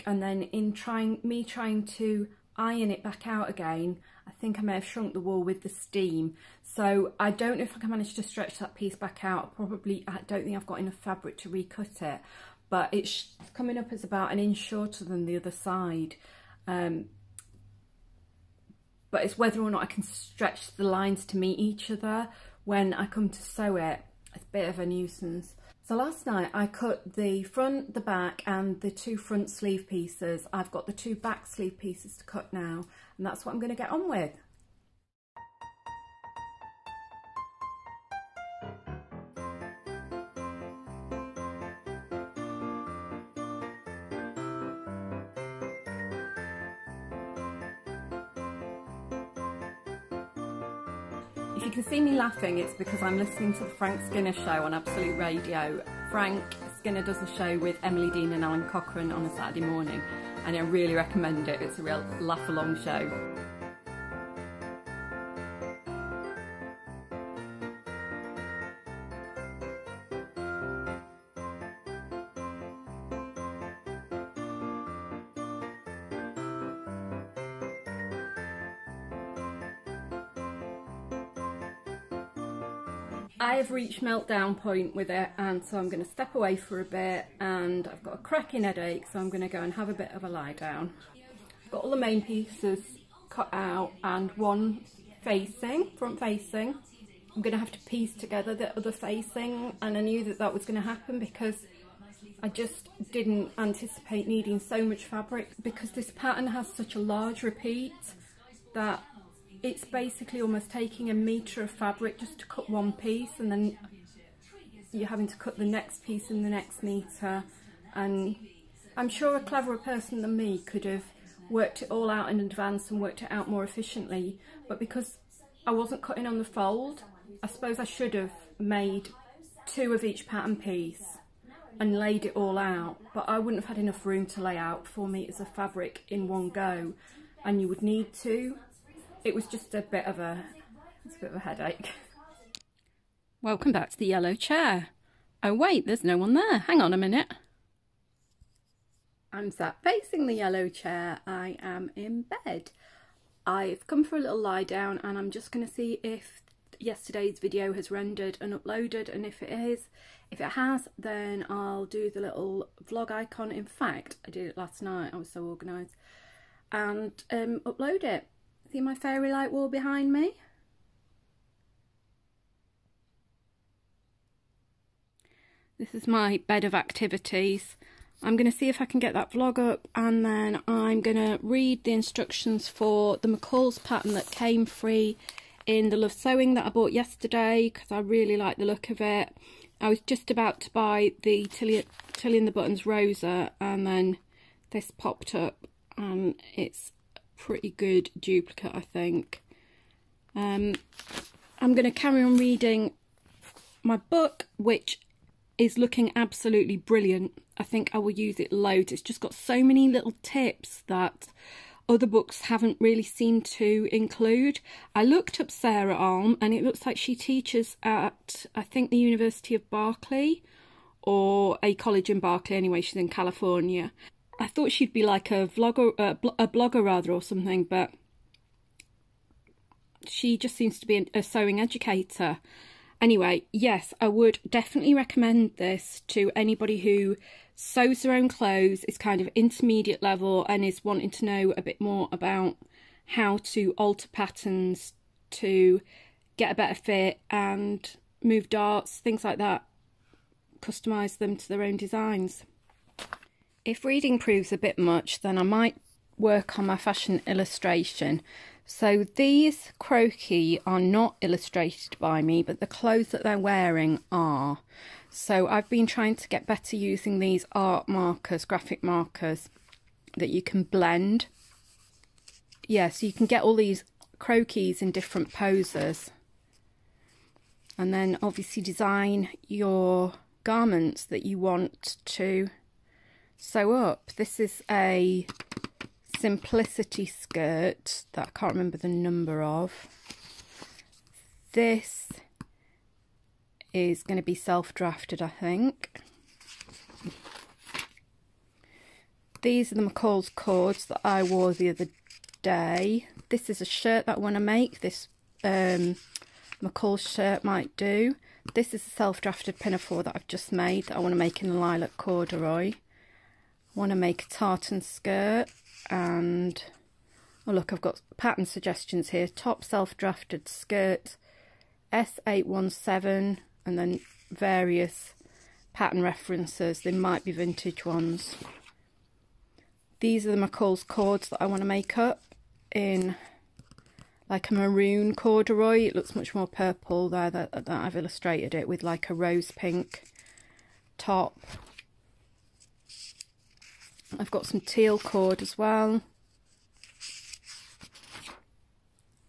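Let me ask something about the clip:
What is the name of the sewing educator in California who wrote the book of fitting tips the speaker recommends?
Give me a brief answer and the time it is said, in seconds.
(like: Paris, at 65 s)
Sarah Alm, at 215 s.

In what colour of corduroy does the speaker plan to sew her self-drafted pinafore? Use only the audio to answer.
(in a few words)
lilac.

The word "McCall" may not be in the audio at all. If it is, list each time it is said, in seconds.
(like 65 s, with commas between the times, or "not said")
183 s, 299 s, 306 s, 330 s.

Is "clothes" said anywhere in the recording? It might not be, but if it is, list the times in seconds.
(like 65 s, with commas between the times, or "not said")
238 s, 262 s.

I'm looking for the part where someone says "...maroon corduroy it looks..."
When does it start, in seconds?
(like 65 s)
334 s.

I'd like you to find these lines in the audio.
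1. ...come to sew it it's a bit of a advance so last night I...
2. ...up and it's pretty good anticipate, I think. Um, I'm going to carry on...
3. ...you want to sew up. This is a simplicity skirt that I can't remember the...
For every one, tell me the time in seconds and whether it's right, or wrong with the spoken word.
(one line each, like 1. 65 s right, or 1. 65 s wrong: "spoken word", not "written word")
1. 23 s wrong: "nuisance", not "advance"
2. 195 s wrong: "duplicate", not "anticipate"
3. 281 s right.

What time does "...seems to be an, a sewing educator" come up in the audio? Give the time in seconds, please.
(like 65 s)
230 s.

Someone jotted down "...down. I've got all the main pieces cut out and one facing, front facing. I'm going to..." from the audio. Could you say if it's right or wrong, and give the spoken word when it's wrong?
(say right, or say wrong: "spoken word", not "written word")
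right.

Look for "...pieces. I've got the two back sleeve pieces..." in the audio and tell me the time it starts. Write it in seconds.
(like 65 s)
29 s.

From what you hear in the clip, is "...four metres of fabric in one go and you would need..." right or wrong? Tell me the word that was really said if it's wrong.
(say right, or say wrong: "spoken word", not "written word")
right.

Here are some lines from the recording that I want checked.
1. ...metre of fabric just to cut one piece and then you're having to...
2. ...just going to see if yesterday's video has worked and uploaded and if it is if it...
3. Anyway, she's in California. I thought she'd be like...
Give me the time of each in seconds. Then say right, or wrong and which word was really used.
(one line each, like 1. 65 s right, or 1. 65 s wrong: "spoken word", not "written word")
1. 111 s right
2. 155 s wrong: "rendered", not "worked"
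3. 222 s right.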